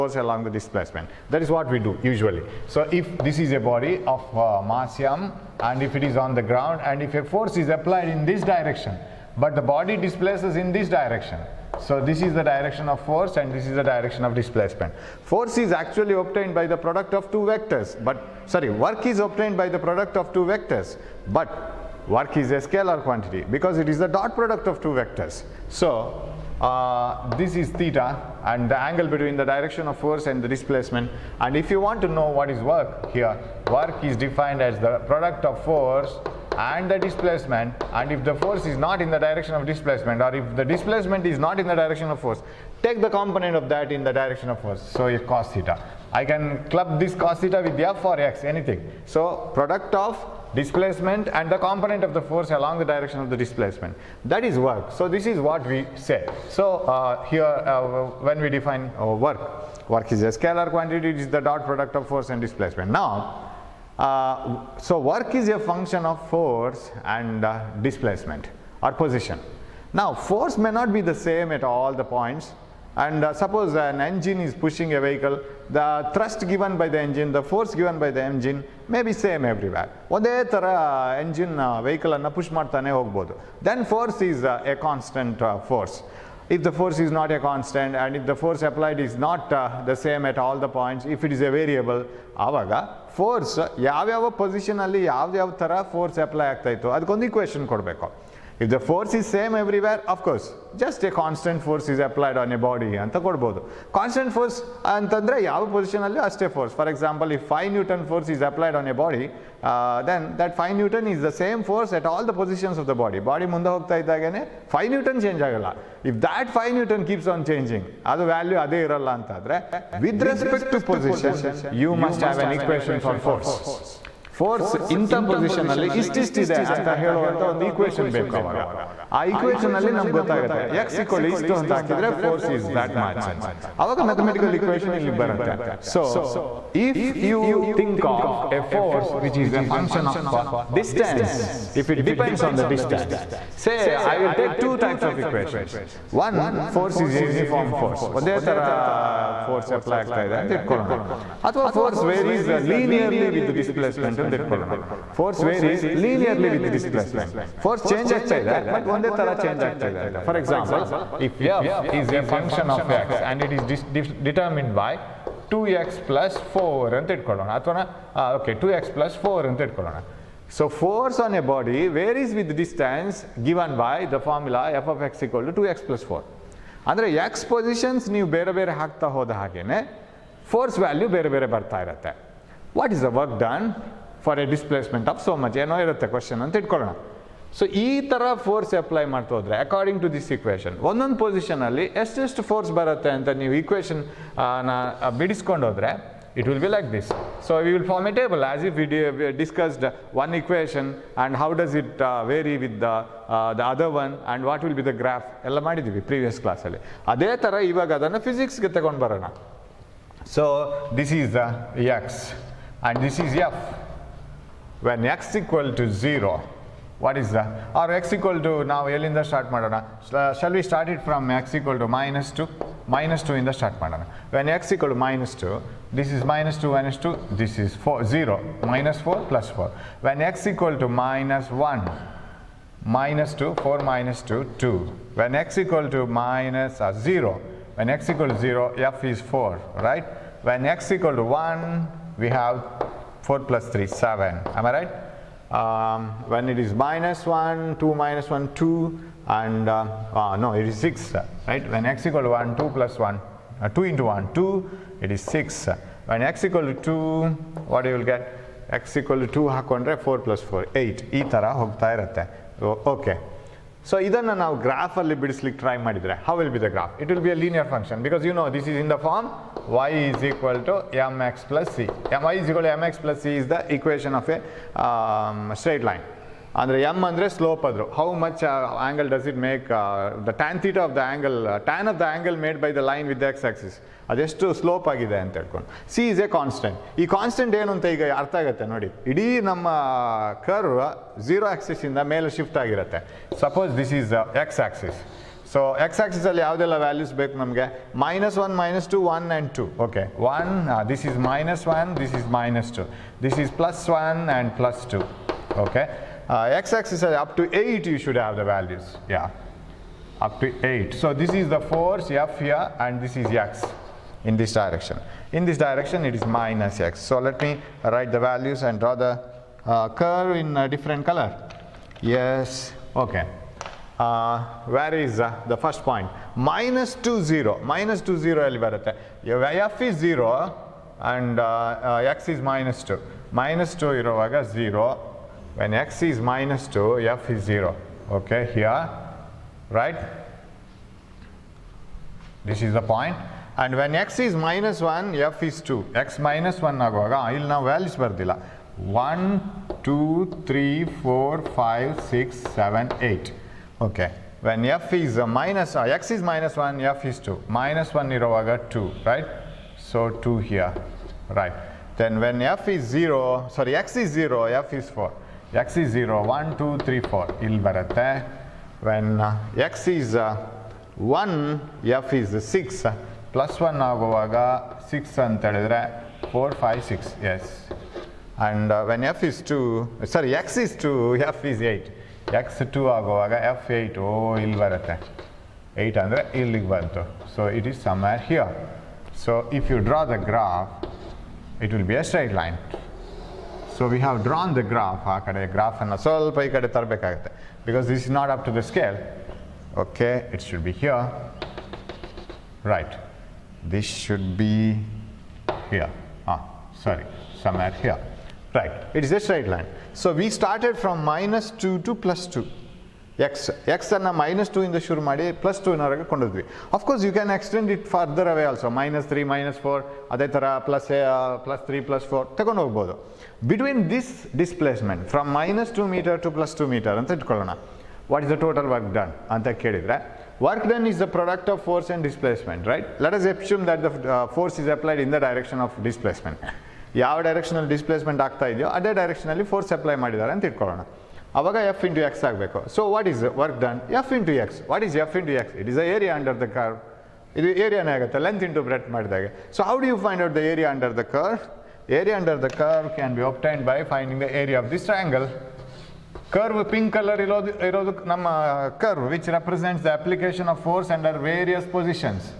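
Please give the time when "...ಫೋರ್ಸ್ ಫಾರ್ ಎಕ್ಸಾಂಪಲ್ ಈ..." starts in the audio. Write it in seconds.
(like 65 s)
106 s.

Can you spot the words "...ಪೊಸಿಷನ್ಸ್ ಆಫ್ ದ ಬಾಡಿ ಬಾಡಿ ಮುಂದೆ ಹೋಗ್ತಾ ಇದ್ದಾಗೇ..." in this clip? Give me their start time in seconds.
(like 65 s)
112 s.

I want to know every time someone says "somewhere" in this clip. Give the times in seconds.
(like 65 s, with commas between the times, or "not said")
387 s, 407 s.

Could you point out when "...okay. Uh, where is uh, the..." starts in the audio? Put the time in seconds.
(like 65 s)
322 s.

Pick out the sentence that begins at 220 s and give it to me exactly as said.
Uh, shall we start it from x equal to minus 2?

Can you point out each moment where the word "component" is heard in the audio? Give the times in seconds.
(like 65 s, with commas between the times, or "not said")
43 s, 51 s.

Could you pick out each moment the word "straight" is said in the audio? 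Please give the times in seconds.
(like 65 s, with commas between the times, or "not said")
275 s, 392 s, 409 s.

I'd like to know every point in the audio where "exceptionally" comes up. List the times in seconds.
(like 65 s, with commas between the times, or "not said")
not said.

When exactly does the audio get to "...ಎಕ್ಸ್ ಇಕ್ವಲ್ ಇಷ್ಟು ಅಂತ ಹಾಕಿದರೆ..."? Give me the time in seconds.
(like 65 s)
130 s.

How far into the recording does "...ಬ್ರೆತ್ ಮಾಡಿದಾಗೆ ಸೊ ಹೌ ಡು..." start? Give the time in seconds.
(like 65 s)
448 s.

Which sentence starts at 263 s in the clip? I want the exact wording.
So, idanna now graph alli bidislik try madidre.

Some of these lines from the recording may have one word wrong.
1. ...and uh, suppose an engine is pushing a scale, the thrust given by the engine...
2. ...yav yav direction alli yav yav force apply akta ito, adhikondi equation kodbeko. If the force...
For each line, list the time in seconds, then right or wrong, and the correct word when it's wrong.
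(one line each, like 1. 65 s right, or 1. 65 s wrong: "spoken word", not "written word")
1. 72 s wrong: "vehicle", not "scale"
2. 93 s wrong: "position", not "direction".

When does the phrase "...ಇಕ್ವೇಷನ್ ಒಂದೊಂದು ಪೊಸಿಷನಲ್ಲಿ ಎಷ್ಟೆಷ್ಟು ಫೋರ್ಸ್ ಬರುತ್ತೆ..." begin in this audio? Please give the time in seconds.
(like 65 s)
190 s.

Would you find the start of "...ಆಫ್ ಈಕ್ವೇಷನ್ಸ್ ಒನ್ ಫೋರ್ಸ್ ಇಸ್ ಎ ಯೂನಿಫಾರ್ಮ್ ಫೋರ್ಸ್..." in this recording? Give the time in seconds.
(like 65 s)
145 s.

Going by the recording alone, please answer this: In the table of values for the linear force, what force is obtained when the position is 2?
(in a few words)
8.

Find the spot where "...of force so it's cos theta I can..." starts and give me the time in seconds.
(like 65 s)
44 s.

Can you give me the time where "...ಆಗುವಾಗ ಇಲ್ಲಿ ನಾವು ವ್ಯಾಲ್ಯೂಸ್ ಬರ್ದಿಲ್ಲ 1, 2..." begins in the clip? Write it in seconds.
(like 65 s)
346 s.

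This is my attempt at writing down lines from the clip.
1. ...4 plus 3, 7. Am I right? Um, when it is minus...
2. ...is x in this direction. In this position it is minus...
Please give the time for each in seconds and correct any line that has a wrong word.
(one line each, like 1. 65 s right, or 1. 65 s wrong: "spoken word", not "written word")
1. 243 s right
2. 313 s wrong: "direction", not "position".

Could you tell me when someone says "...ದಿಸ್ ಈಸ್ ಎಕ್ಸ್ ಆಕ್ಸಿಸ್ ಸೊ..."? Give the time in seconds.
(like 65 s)
293 s.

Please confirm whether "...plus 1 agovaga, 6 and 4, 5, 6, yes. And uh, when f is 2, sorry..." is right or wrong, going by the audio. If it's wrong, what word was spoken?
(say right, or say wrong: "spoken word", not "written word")
right.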